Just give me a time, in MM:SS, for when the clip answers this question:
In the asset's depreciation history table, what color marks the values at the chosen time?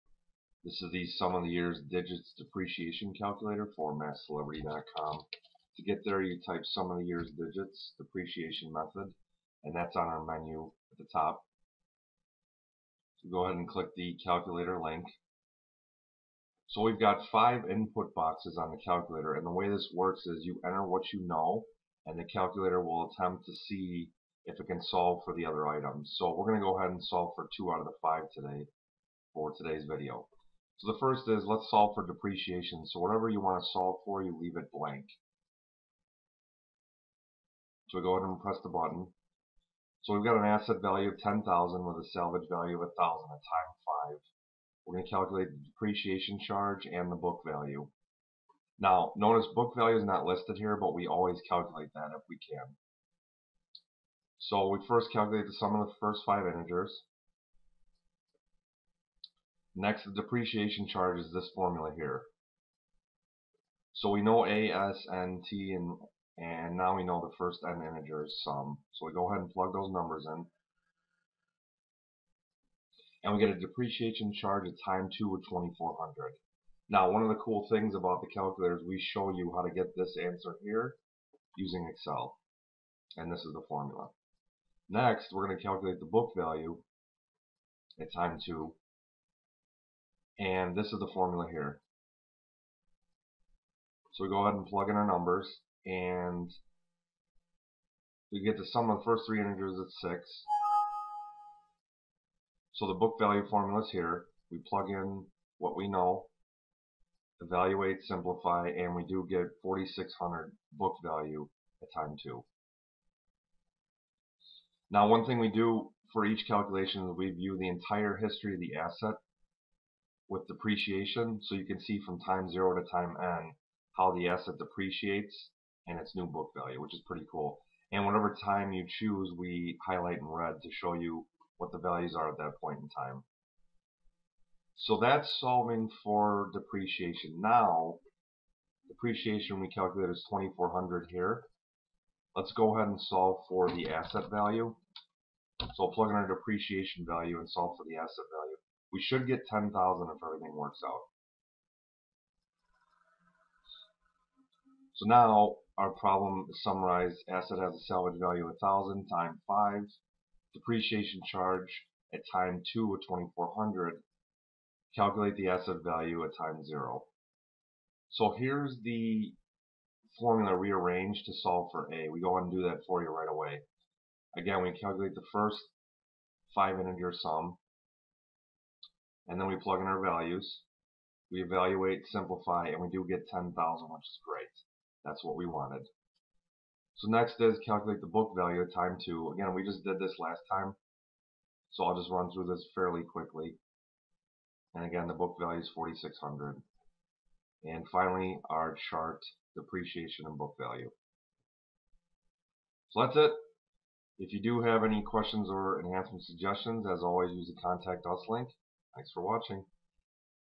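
02:10.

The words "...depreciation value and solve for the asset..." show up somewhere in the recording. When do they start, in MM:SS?
02:26.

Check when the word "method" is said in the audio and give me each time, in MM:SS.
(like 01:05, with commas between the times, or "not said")
00:08.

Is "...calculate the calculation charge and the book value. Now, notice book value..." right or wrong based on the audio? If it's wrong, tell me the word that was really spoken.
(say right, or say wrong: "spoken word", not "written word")
wrong: "depreciation", not "calculation".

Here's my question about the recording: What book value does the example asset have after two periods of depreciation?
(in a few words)
4600.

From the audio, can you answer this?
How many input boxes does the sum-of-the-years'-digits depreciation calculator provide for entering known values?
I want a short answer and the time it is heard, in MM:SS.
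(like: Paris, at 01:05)
5, at 00:17.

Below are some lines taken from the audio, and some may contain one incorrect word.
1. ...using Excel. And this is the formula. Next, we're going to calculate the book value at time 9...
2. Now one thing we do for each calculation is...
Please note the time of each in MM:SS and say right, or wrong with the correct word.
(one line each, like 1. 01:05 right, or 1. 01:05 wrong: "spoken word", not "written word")
1. 01:21 wrong: "2", not "9"
2. 01:54 right.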